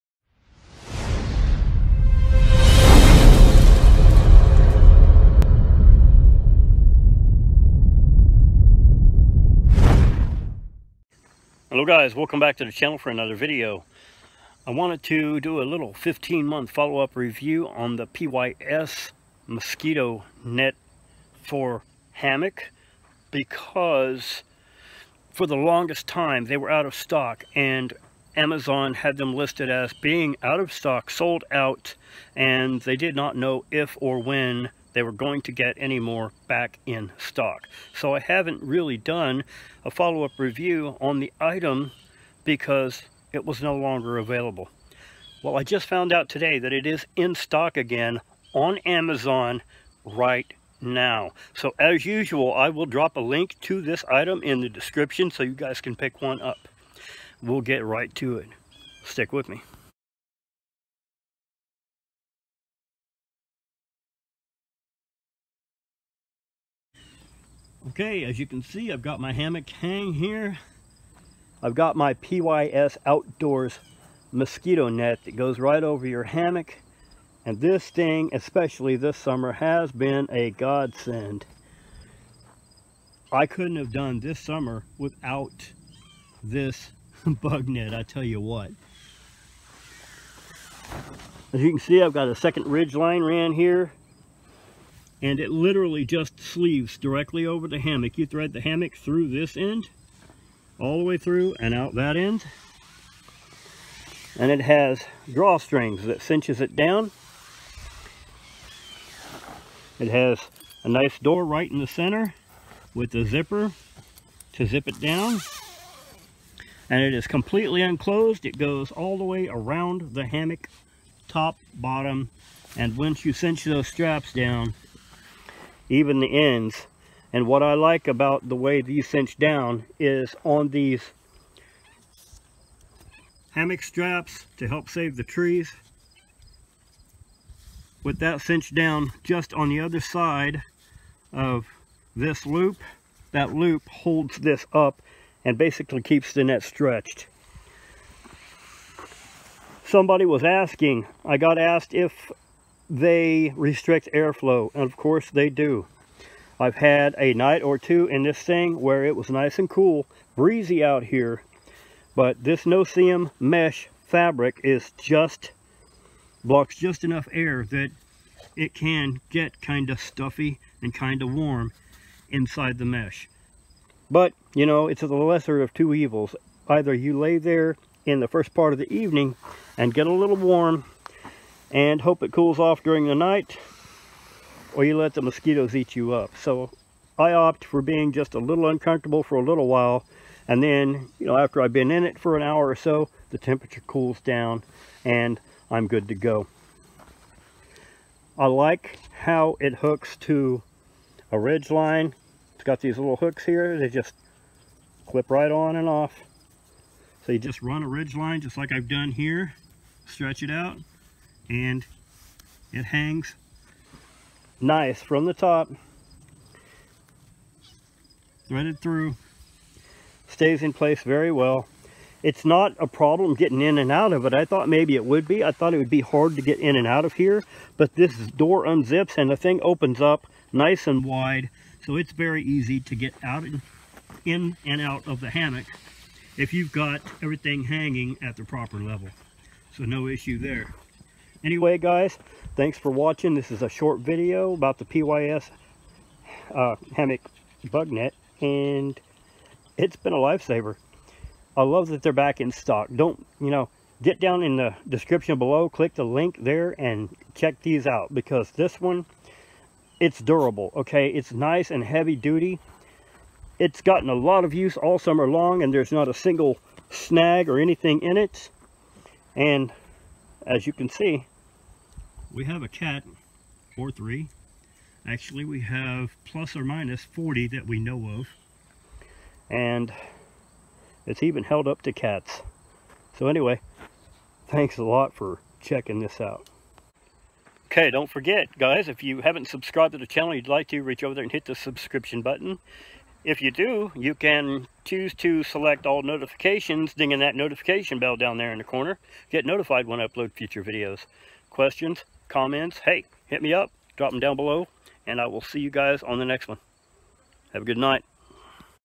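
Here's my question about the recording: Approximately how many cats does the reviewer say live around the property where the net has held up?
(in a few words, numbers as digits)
40.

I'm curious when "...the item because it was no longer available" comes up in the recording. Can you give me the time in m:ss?
0:41.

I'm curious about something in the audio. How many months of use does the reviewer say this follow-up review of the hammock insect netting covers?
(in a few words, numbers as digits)
15.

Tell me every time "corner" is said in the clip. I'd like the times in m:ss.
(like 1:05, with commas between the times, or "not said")
4:58.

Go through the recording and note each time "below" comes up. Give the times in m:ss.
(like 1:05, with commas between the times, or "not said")
4:15, 5:04.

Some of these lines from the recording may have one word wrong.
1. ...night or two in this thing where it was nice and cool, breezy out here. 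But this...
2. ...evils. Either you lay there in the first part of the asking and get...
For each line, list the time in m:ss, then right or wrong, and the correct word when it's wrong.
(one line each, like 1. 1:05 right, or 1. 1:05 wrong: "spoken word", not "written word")
1. 2:37 right
2. 2:55 wrong: "evening", not "asking".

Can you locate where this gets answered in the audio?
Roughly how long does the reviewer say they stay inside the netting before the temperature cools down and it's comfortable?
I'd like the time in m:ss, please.
3:12.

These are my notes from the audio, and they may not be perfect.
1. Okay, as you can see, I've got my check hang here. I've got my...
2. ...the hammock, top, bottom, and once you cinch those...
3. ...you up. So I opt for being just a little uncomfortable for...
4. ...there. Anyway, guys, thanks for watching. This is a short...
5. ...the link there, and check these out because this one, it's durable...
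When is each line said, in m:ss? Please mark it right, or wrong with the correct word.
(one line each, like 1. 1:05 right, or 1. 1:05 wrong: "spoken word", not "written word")
1. 1:07 wrong: "hammock", not "check"
2. 2:00 right
3. 3:05 right
4. 4:00 right
5. 4:15 right.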